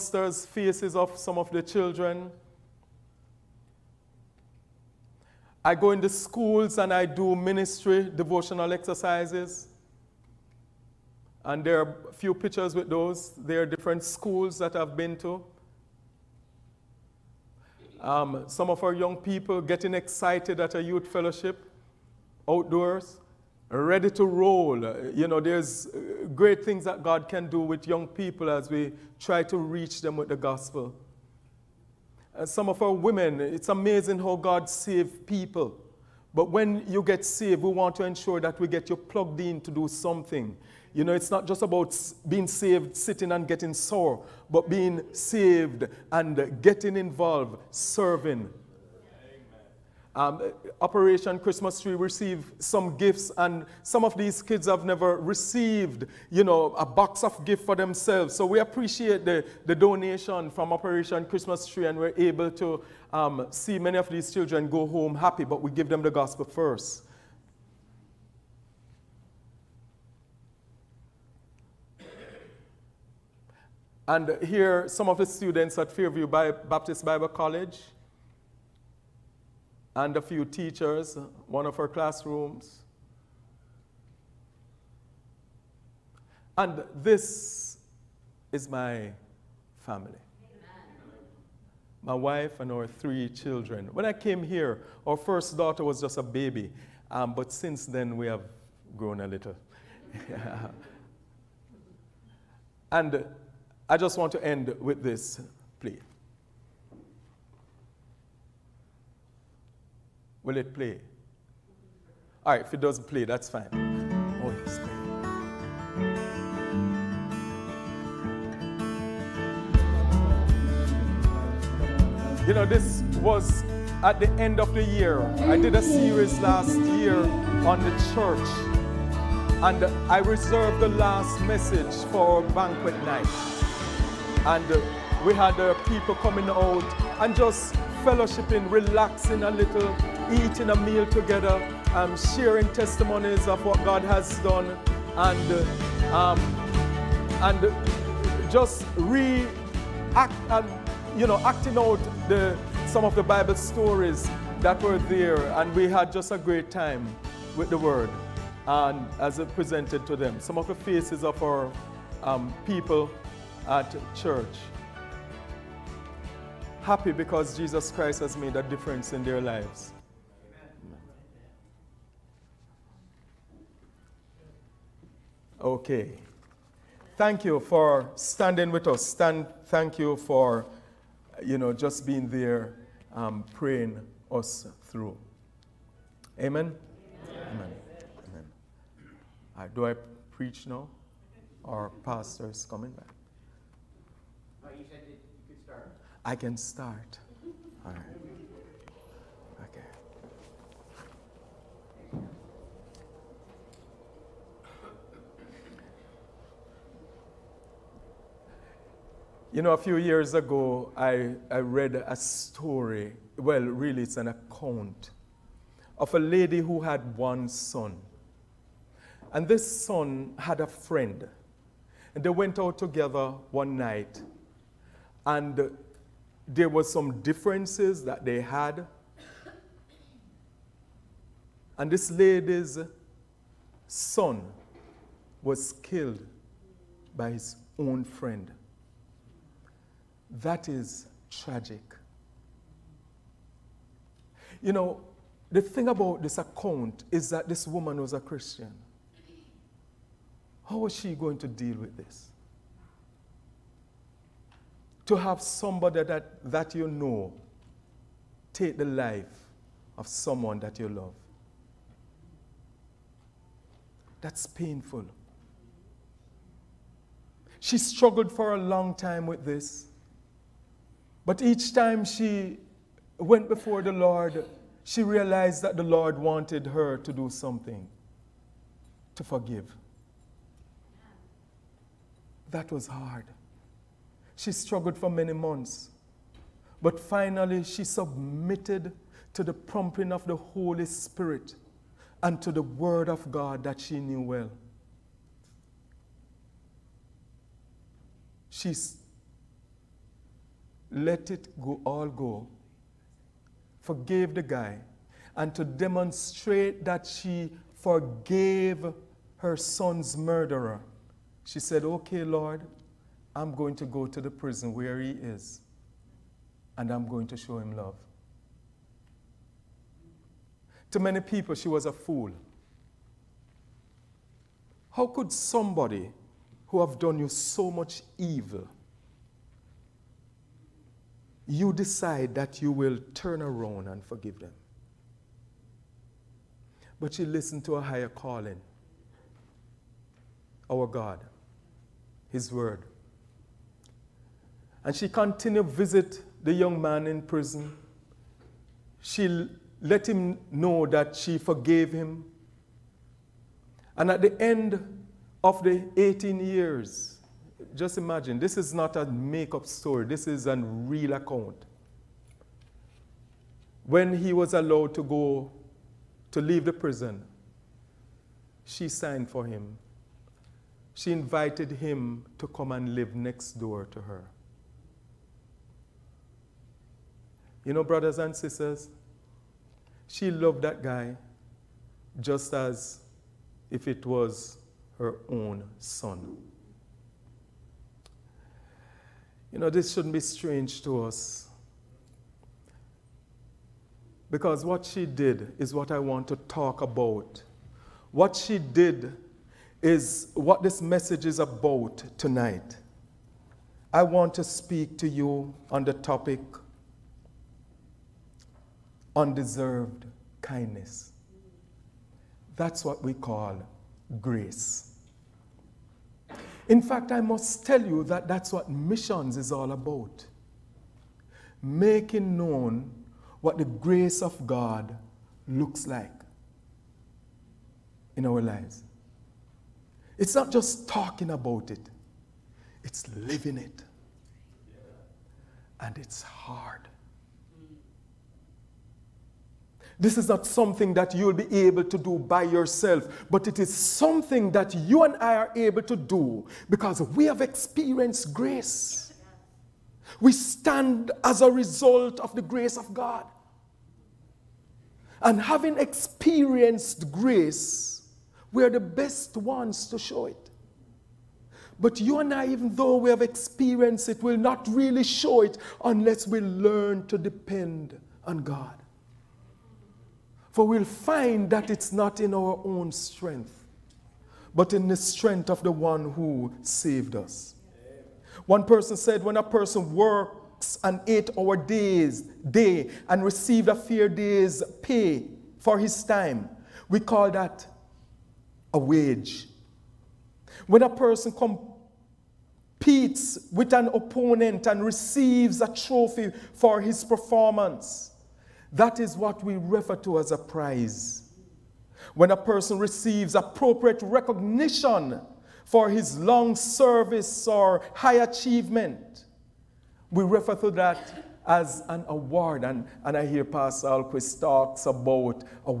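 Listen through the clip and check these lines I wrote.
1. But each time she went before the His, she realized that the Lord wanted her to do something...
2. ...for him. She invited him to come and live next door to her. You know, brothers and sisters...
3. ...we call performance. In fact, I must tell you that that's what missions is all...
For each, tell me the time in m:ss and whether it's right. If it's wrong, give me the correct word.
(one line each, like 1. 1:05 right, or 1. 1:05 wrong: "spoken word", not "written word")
1. 4:31 wrong: "Lord", not "His"
2. 6:09 right
3. 6:53 wrong: "grace", not "performance".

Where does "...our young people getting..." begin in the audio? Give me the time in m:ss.
0:18.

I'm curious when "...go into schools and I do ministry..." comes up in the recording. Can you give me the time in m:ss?
0:05.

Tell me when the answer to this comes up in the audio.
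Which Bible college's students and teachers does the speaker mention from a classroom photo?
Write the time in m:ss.
1:15.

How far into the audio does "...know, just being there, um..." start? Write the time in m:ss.
3:01.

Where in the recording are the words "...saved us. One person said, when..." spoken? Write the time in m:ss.
7:56.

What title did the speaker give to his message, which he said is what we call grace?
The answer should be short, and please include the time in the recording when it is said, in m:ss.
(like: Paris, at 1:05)
Undeserved kindness, at 6:49.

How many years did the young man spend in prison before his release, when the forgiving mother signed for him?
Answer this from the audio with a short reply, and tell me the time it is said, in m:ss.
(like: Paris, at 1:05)
18, at 5:55.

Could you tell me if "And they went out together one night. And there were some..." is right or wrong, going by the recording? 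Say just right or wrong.
right.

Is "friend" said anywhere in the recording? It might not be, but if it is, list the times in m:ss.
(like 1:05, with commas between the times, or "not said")
3:40, 3:58.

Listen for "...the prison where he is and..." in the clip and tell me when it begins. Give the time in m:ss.
5:14.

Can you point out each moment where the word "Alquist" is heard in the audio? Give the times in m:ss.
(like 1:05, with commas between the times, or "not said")
8:33.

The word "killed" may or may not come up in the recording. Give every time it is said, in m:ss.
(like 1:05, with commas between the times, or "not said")
3:55.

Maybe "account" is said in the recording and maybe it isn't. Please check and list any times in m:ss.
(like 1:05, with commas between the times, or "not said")
3:34, 4:06, 6:01.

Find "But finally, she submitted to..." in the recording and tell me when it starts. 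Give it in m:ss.
4:46.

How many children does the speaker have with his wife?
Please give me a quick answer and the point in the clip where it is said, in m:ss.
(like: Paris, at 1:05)
3, at 1:32.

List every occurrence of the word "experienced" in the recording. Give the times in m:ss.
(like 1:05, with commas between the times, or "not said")
7:27, 7:35, 7:43.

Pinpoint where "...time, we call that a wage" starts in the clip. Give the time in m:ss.
8:06.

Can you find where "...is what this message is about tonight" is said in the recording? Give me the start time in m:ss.
6:39.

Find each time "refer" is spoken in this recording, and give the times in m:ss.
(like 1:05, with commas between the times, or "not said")
8:19, 8:30.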